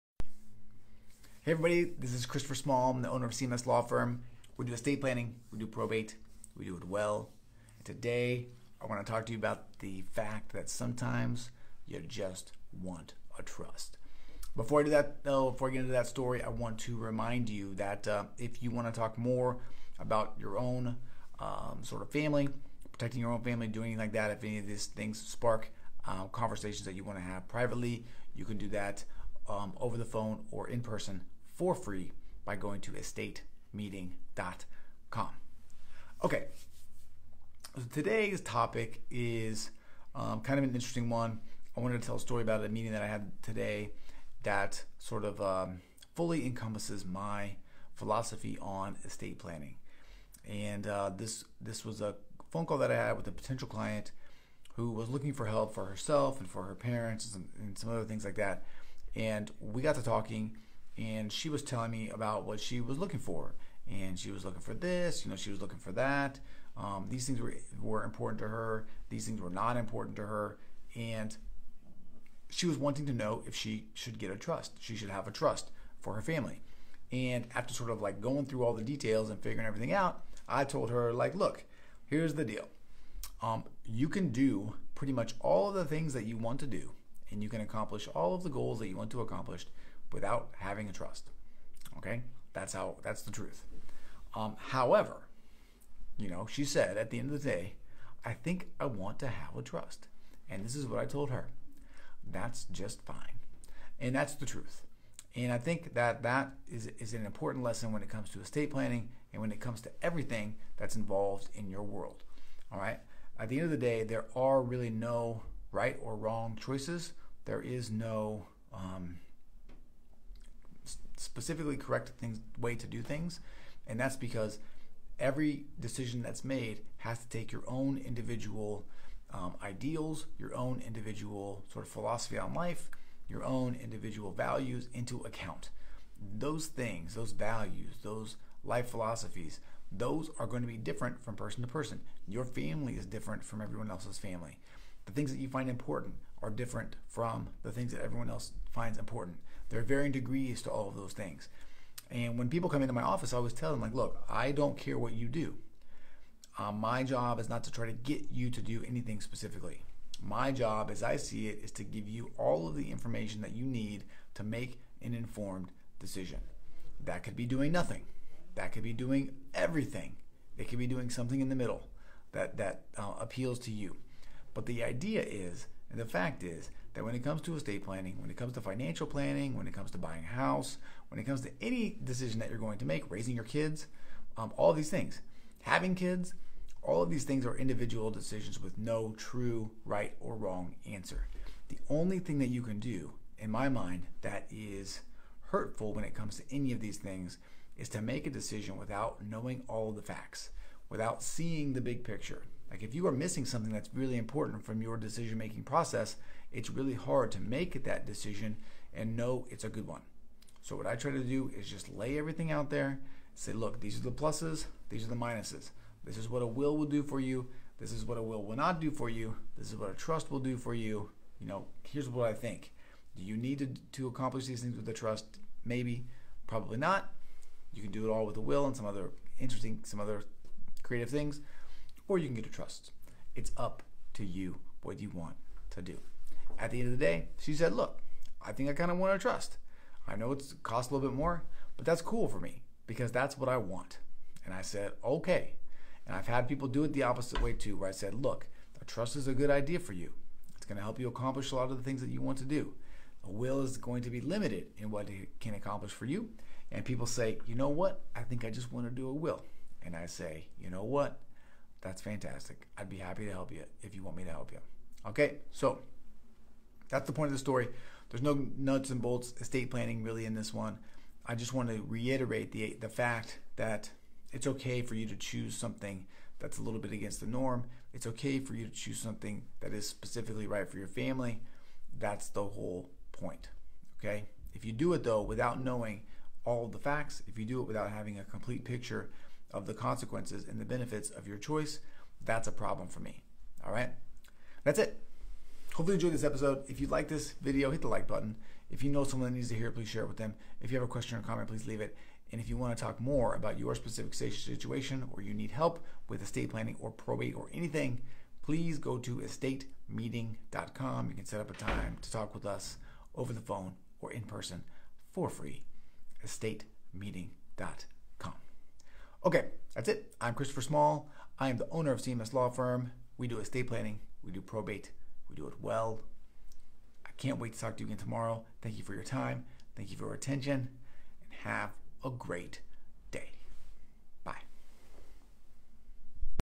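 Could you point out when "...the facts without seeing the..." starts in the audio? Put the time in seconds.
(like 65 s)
199 s.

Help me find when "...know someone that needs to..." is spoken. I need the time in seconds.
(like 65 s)
298 s.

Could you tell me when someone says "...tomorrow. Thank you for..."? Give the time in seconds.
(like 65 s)
327 s.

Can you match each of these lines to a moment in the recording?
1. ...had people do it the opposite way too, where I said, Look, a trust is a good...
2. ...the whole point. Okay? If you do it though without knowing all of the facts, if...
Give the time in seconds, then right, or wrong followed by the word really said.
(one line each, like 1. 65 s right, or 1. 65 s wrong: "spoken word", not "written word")
1. 246 s right
2. 282 s right.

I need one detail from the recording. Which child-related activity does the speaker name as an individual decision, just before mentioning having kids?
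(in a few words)
Raising your kids.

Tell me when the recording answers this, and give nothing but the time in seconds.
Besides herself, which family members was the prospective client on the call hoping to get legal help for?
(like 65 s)
56 s.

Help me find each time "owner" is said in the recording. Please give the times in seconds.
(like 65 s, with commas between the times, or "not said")
3 s, 321 s.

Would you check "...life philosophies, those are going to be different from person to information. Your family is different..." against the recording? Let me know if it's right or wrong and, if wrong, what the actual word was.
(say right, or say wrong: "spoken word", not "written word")
wrong: "person", not "information".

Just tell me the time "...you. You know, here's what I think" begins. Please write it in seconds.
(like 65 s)
220 s.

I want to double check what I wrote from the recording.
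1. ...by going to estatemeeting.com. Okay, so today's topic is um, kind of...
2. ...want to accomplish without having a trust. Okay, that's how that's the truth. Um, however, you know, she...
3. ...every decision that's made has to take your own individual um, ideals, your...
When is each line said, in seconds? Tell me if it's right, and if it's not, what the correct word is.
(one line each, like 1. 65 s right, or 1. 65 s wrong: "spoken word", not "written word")
1. 32 s right
2. 88 s right
3. 125 s right.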